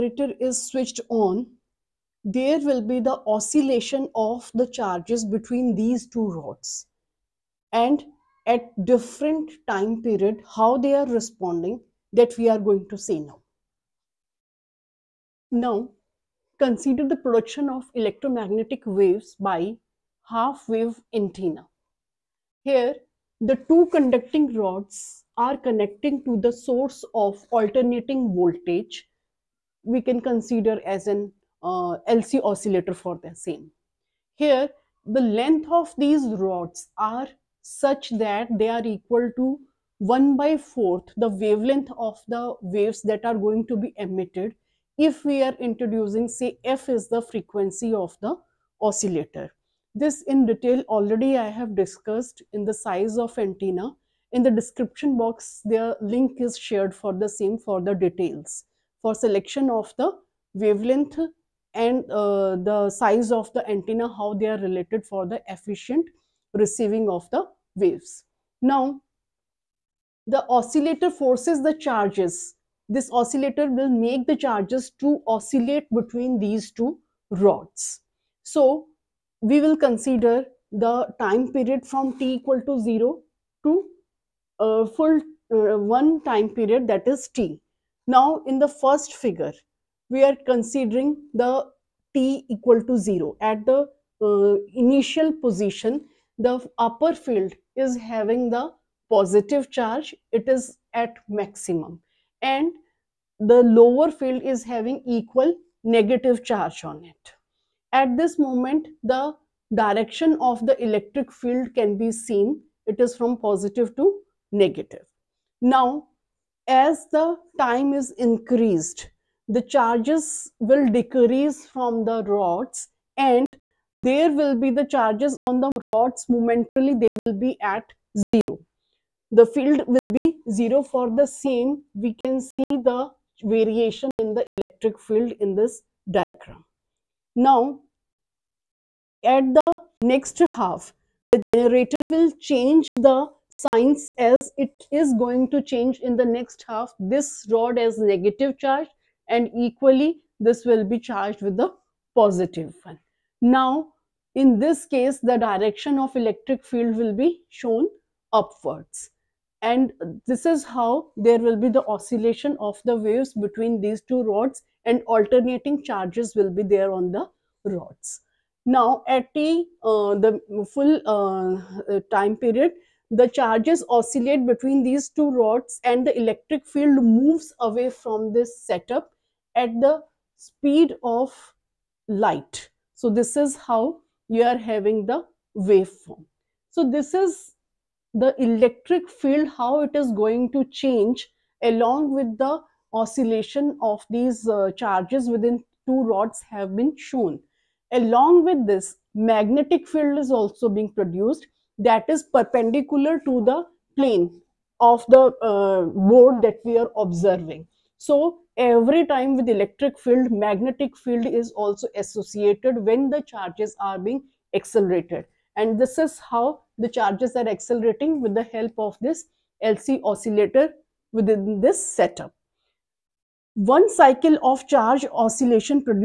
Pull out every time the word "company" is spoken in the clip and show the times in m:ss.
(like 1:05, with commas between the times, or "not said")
not said.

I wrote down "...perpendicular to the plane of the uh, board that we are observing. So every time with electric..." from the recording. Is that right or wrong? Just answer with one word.
right.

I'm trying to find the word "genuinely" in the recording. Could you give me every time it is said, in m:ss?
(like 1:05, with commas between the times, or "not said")
not said.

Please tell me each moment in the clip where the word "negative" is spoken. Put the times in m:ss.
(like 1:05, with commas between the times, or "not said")
1:45, 1:54, 2:27.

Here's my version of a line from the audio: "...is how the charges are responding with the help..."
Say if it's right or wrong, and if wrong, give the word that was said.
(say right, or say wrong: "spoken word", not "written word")
wrong: "accelerating", not "responding".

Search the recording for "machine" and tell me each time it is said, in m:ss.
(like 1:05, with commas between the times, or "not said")
not said.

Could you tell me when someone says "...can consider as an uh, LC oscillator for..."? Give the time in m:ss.
0:30.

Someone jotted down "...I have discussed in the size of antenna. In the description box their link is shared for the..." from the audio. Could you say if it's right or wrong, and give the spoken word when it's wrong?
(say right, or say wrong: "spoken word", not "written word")
right.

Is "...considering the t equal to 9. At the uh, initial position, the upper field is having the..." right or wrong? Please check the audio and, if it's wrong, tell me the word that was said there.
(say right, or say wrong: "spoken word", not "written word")
wrong: "0", not "9".